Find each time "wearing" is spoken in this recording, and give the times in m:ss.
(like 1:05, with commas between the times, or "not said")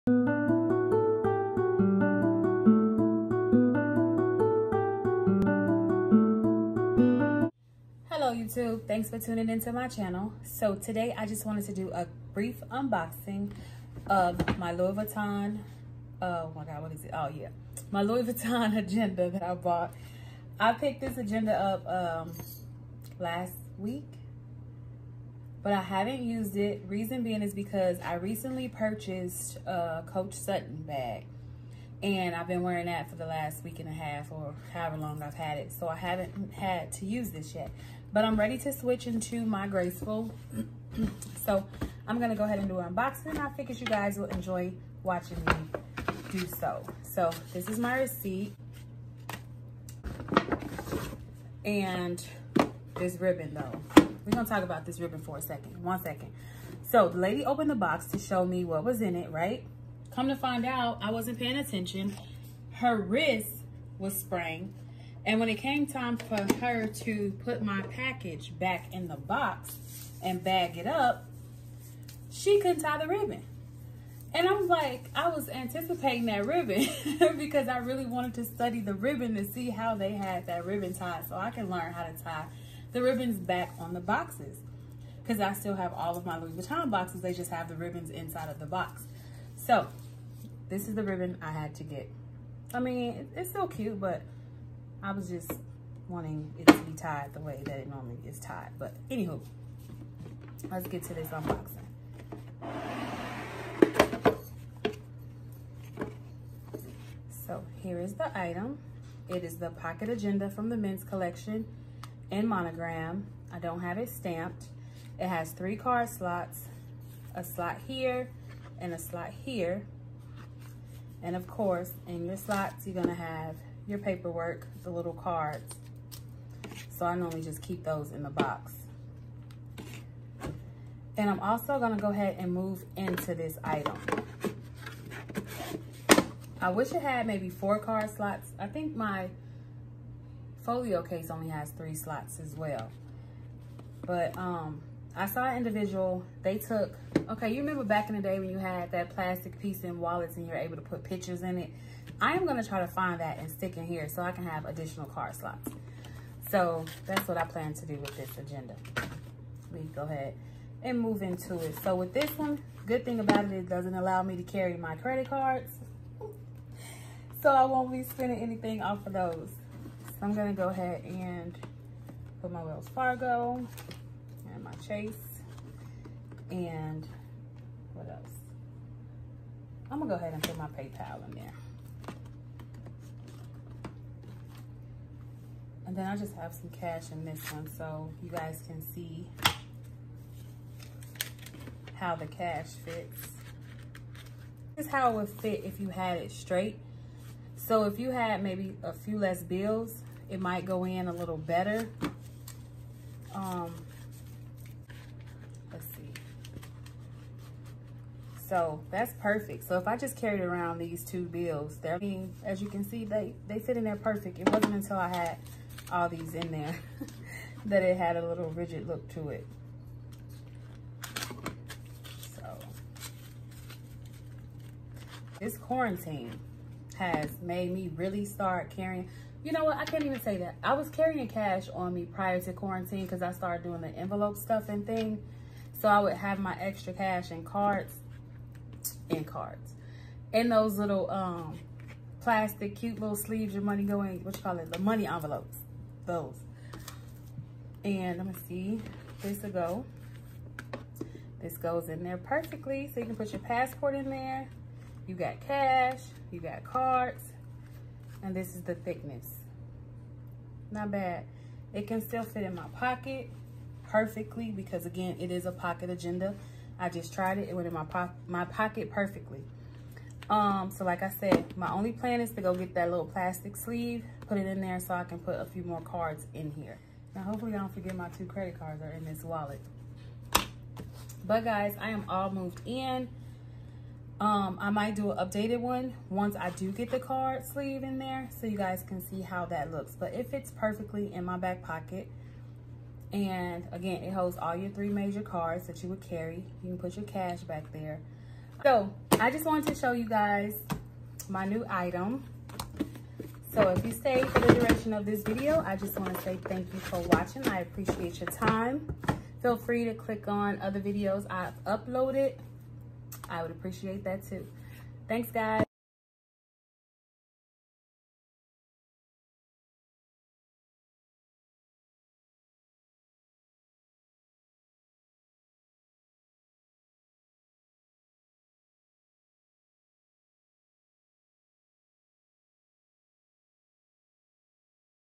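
0:32.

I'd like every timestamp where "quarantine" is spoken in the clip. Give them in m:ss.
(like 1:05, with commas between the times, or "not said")
3:45, 3:52.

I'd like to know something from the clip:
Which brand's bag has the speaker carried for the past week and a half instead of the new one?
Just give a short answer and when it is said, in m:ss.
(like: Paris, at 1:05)
Coach, at 0:30.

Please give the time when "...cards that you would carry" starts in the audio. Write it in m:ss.
4:55.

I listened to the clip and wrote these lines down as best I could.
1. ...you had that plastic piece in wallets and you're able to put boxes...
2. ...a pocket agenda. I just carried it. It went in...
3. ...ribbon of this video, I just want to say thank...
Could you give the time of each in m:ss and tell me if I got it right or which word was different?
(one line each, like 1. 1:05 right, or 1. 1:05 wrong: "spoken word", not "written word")
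1. 2:28 wrong: "pictures", not "boxes"
2. 4:25 wrong: "tried", not "carried"
3. 5:04 wrong: "duration", not "ribbon".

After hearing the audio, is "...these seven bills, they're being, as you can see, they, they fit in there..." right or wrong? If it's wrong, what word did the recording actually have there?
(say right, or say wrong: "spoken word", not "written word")
wrong: "two", not "seven".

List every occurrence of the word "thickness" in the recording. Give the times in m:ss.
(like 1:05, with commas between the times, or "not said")
4:18.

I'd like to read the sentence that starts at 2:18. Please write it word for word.
I think my folio case only has three slots as well.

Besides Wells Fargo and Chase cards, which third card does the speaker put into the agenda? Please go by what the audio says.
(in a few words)
PayPal.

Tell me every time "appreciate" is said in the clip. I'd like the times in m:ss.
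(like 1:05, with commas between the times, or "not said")
5:07, 5:13.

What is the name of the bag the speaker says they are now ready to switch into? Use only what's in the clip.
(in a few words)
Graceful.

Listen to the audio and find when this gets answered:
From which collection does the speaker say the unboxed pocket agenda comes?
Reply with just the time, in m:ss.
1:50.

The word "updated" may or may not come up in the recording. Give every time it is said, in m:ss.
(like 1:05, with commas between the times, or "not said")
4:45.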